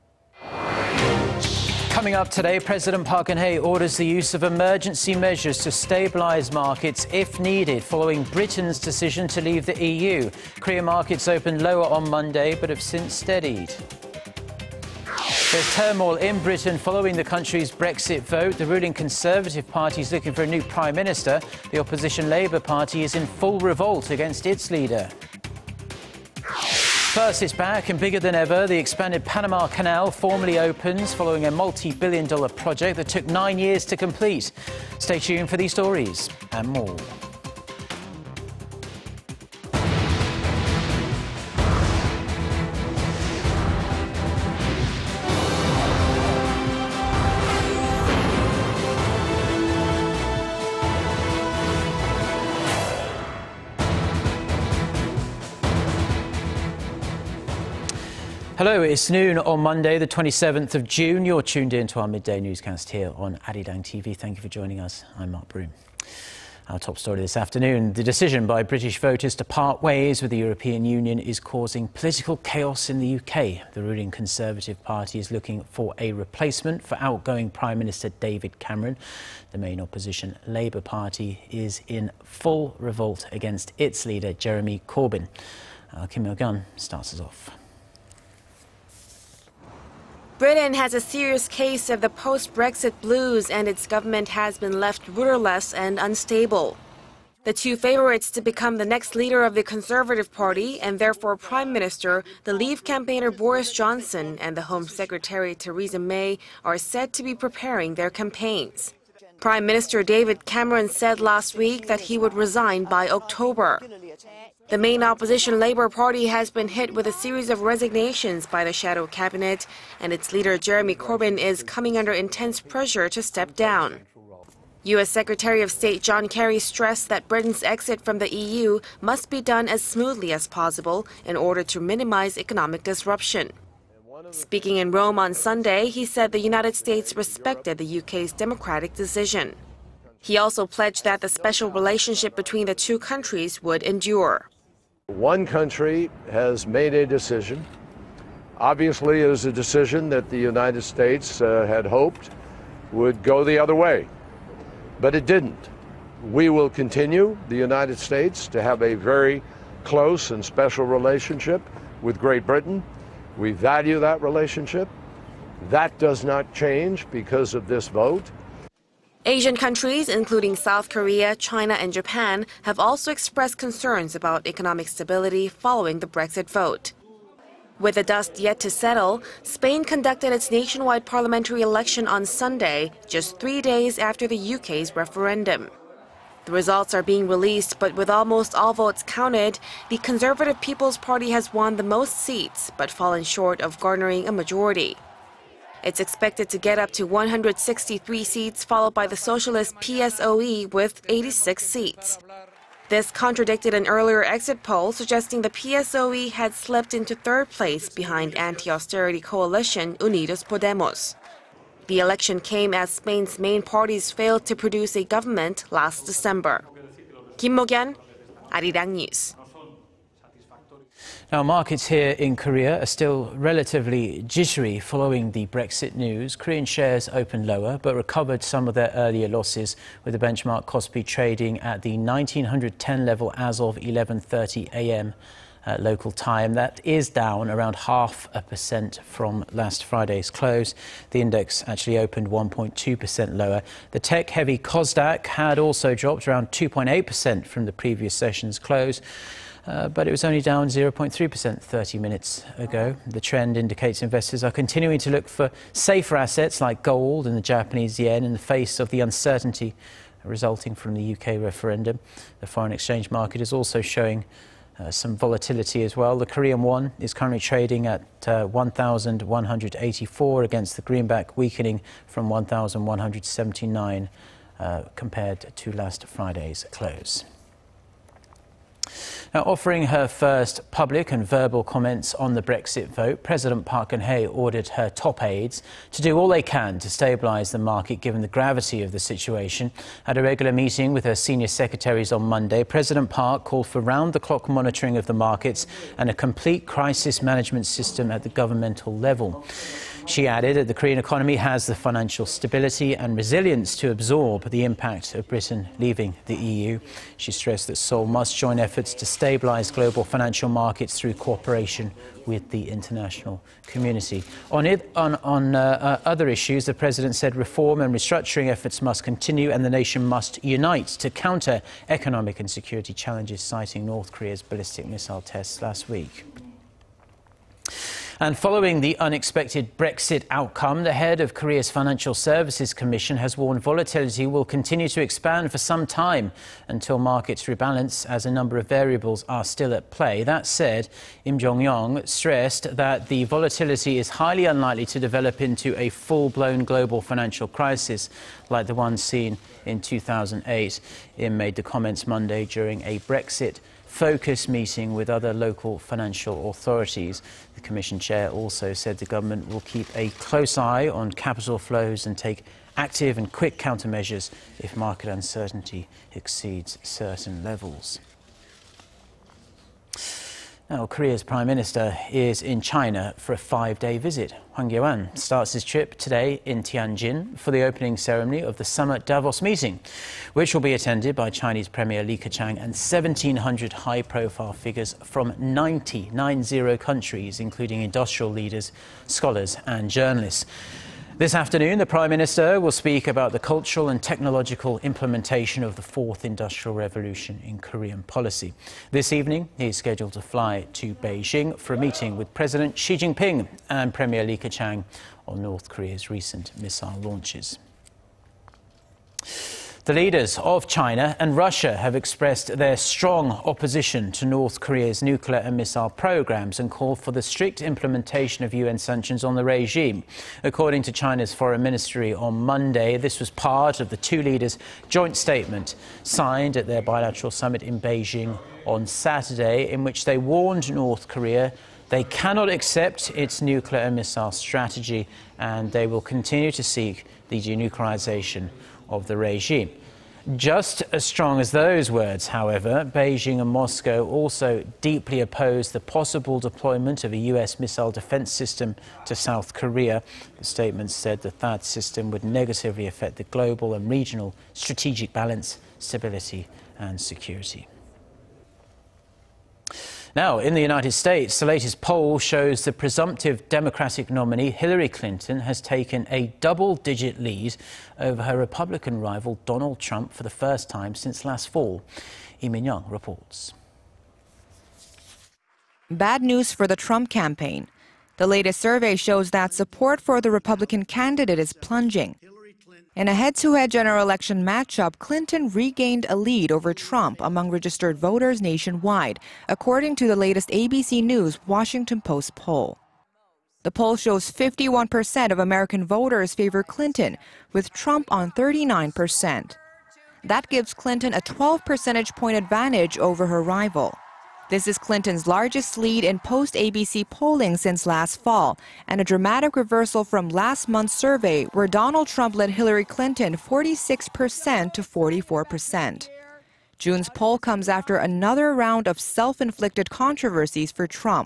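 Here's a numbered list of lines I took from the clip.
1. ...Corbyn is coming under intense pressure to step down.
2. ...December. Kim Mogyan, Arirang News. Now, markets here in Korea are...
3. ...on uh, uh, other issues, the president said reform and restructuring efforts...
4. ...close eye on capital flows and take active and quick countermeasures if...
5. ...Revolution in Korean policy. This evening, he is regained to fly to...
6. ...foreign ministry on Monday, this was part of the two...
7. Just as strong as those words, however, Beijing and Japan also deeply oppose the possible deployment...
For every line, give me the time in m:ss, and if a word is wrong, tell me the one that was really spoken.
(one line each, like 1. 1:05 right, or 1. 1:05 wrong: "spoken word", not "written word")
1. 2:00 right
2. 3:36 right
3. 5:15 right
4. 6:00 right
5. 6:36 wrong: "scheduled", not "regained"
6. 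7:01 right
7. 7:20 wrong: "Moscow", not "Japan".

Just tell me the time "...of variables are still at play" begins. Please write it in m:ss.
5:38.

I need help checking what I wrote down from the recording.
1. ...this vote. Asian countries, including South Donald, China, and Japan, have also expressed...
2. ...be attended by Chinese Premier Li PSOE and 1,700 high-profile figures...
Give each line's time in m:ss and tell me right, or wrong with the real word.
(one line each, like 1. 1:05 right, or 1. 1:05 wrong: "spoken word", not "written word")
1. 2:47 wrong: "Korea", not "Donald"
2. 6:20 wrong: "Keqiang", not "PSOE".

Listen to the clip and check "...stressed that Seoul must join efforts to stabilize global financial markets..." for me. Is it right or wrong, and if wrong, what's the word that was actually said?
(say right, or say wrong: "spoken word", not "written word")
right.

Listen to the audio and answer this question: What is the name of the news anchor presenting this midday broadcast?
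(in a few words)
Mark Broom.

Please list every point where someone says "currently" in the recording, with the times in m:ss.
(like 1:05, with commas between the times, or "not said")
4:27.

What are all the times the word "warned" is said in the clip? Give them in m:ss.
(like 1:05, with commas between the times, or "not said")
5:33, 7:10.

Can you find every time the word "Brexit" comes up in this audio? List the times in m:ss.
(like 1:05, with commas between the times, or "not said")
0:17, 1:32, 2:56, 3:45, 4:42, 5:29, 5:52.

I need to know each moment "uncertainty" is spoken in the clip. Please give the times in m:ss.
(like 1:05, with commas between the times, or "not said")
4:18, 6:05.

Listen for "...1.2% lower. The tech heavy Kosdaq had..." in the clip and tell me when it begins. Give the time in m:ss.
4:02.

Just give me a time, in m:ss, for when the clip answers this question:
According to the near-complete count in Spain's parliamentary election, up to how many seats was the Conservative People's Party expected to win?
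3:17.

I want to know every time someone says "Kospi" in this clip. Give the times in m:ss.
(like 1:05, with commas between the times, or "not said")
3:50.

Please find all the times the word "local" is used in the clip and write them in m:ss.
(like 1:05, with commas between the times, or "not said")
3:55, 5:55.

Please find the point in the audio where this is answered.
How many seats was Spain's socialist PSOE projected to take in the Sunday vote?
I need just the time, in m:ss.
3:21.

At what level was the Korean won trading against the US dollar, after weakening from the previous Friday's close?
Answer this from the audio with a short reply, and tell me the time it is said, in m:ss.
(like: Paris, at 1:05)
1,184, at 4:28.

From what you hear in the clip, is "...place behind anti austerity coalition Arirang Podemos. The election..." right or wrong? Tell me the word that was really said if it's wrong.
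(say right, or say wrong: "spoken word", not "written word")
wrong: "Unidos", not "Arirang".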